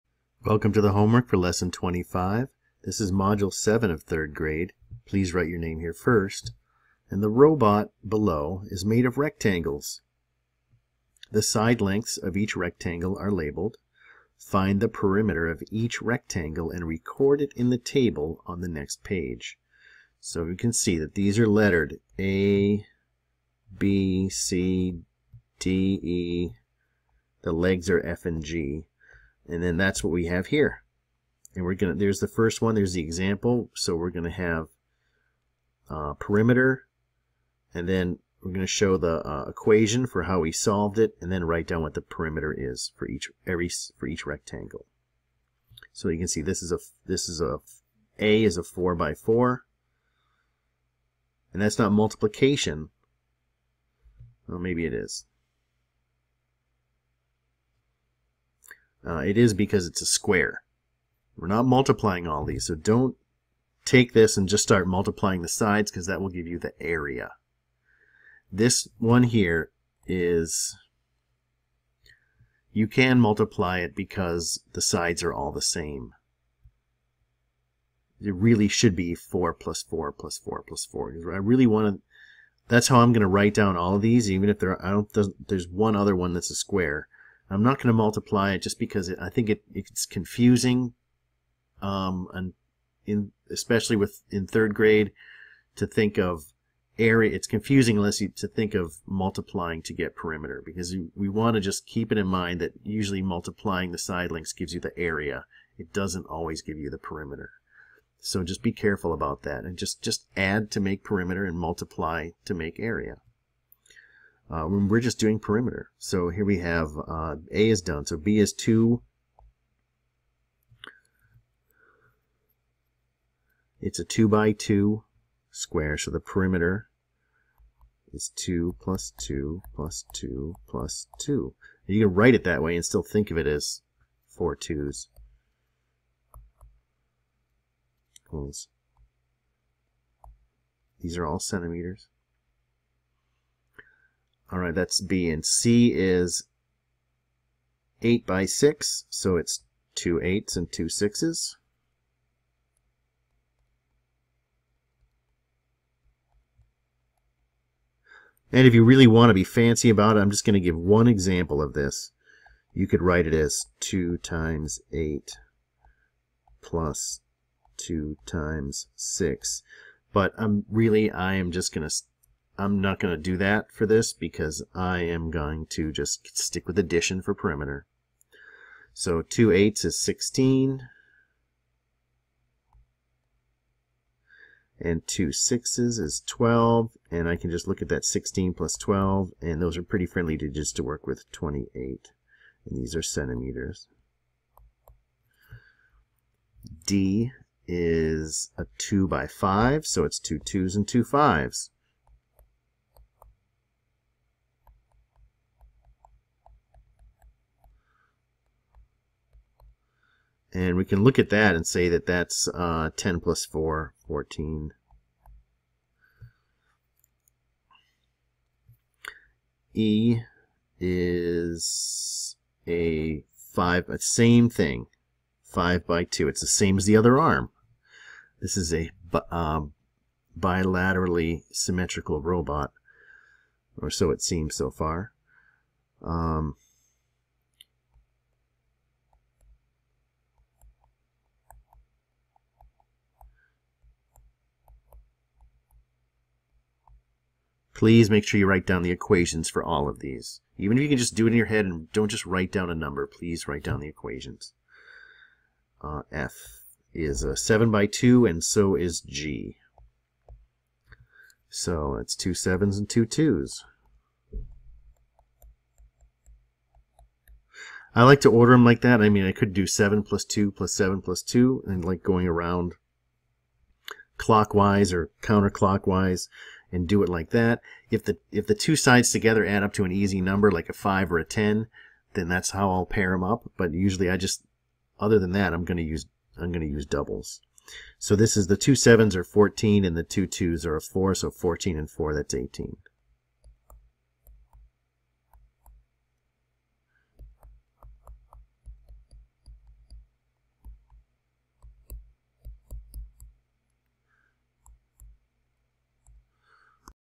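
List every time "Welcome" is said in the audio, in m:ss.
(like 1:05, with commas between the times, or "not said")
0:00.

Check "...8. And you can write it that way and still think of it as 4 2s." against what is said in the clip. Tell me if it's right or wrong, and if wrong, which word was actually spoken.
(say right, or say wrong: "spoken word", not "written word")
wrong: "2", not "8".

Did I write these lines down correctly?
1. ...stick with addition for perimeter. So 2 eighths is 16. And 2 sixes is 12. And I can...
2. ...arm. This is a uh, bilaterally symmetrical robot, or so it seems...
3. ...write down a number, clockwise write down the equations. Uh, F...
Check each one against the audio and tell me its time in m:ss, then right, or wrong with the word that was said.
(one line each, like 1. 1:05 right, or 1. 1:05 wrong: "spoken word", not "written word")
1. 2:56 right
2. 3:47 right
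3. 4:12 wrong: "please", not "clockwise".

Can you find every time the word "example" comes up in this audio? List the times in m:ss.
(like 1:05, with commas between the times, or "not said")
0:33, 2:41.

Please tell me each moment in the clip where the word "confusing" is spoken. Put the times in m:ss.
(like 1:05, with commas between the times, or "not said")
1:30, 1:37.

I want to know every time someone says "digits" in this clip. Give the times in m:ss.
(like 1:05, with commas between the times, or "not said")
3:10.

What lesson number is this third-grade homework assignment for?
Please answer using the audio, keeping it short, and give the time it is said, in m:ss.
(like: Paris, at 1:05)
25, at 0:01.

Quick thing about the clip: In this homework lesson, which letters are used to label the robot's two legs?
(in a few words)
F and G.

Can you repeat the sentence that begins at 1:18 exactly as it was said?
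It really should be 4 plus 4 plus 4 plus 4.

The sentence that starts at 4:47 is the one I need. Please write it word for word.
So this is the two sevens are 14 and the two twos are a 4, so 14 and 4 that's 18.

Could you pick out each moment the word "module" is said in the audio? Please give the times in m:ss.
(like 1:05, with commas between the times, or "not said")
0:03.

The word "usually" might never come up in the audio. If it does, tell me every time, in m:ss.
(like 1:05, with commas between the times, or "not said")
1:42, 4:43.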